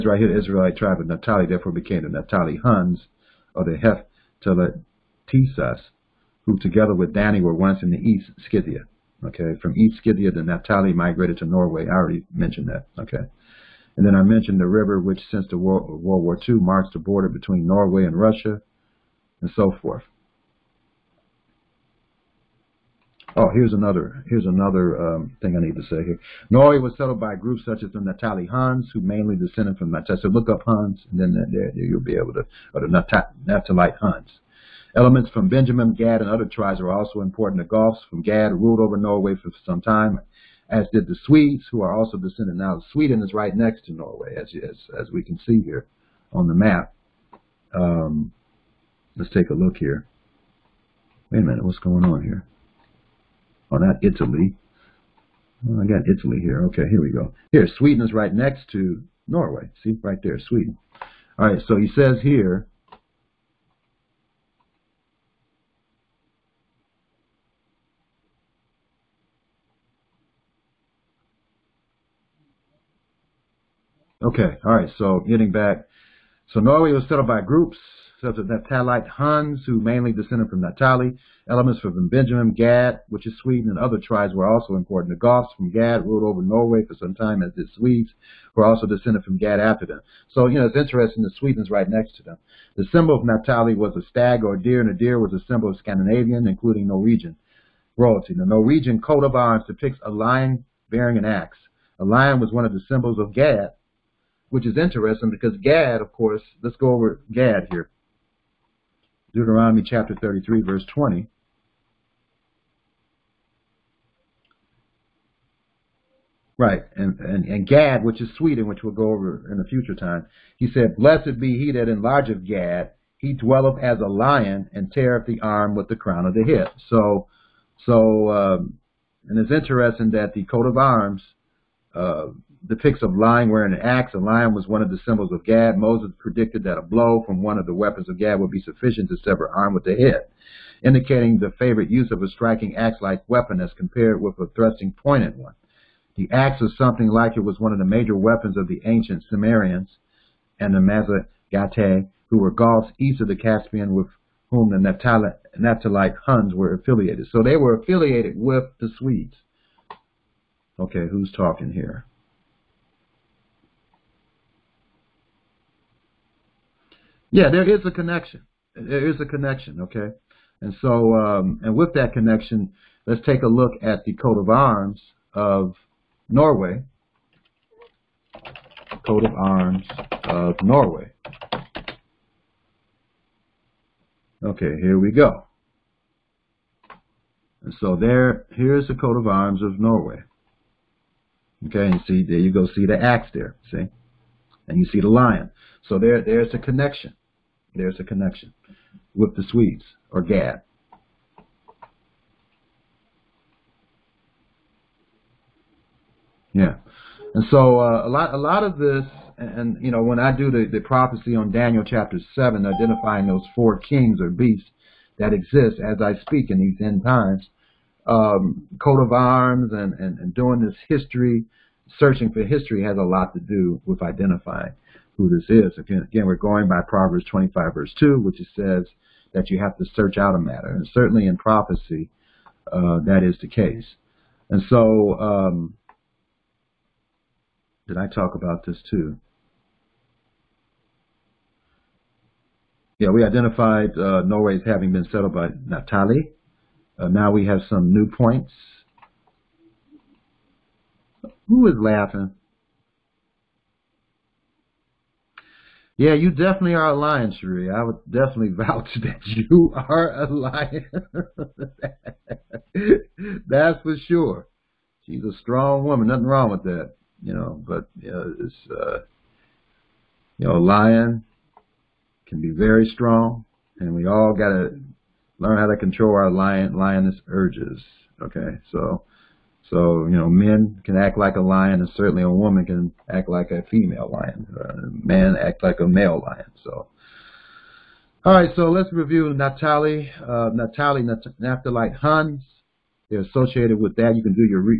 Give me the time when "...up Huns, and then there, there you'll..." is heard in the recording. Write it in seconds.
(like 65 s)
30 s.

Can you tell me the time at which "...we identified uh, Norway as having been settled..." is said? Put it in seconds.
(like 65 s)
243 s.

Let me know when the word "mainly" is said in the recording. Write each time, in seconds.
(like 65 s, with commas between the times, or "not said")
29 s, 79 s.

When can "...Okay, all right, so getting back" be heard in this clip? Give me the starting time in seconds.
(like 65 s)
74 s.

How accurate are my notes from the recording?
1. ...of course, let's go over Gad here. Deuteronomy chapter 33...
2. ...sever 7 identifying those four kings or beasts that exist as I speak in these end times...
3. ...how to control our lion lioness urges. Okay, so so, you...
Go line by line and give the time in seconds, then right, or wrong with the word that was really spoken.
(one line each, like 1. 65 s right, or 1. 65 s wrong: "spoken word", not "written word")
1. 106 s right
2. 211 s wrong: "chapter", not "sever"
3. 275 s right.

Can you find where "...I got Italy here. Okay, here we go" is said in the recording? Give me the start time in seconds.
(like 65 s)
55 s.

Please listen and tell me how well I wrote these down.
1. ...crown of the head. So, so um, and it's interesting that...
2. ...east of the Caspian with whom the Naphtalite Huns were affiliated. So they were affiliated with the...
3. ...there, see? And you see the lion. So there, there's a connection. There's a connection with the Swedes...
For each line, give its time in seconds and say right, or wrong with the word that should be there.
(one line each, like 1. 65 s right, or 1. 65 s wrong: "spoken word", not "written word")
1. 125 s right
2. 152 s right
3. 193 s right.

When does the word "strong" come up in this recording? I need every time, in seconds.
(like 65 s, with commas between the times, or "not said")
265 s, 272 s.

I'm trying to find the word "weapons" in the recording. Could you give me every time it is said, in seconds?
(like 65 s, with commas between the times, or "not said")
137 s, 143 s, 148 s.